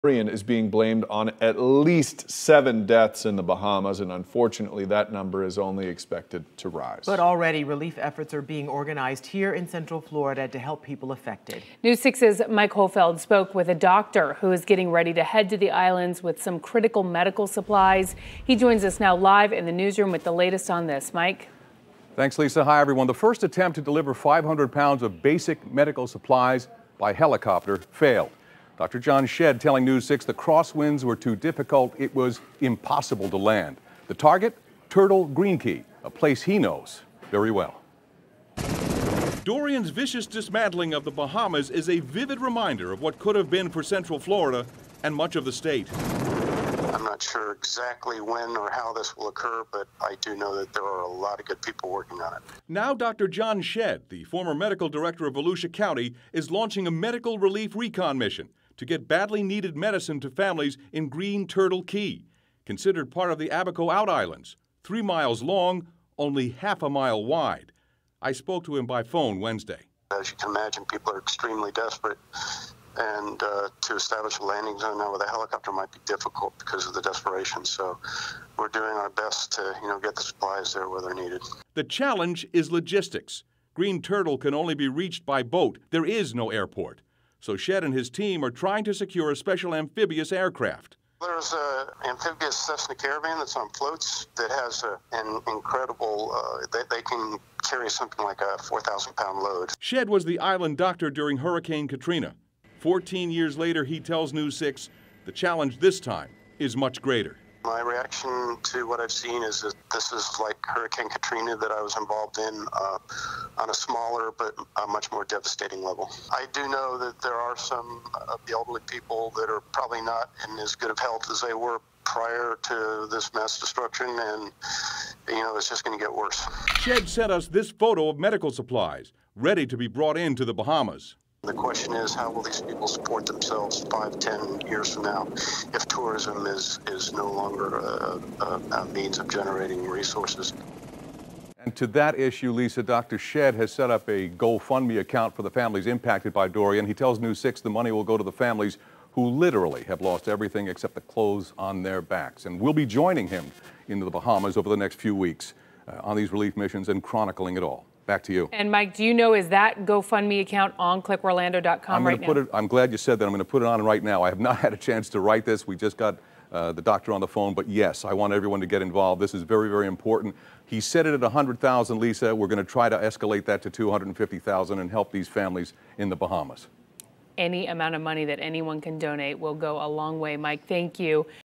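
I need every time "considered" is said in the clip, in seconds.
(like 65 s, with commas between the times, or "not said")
62 s.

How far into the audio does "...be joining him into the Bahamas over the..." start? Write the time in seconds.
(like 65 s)
152 s.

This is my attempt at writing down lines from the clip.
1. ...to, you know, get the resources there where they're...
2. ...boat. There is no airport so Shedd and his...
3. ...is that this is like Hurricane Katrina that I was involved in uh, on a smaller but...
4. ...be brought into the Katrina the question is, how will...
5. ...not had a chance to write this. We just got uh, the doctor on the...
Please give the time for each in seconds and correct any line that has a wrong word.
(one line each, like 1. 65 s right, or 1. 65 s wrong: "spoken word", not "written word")
1. 79 s wrong: "supplies", not "resources"
2. 85 s right
3. 109 s right
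4. 129 s wrong: "Bahamas", not "Katrina"
5. 164 s right.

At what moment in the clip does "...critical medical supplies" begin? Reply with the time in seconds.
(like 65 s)
16 s.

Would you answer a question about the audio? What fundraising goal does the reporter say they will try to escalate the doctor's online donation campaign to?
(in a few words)
250,000.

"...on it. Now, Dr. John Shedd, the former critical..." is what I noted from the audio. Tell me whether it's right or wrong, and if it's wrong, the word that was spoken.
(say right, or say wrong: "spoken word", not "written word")
wrong: "medical", not "critical".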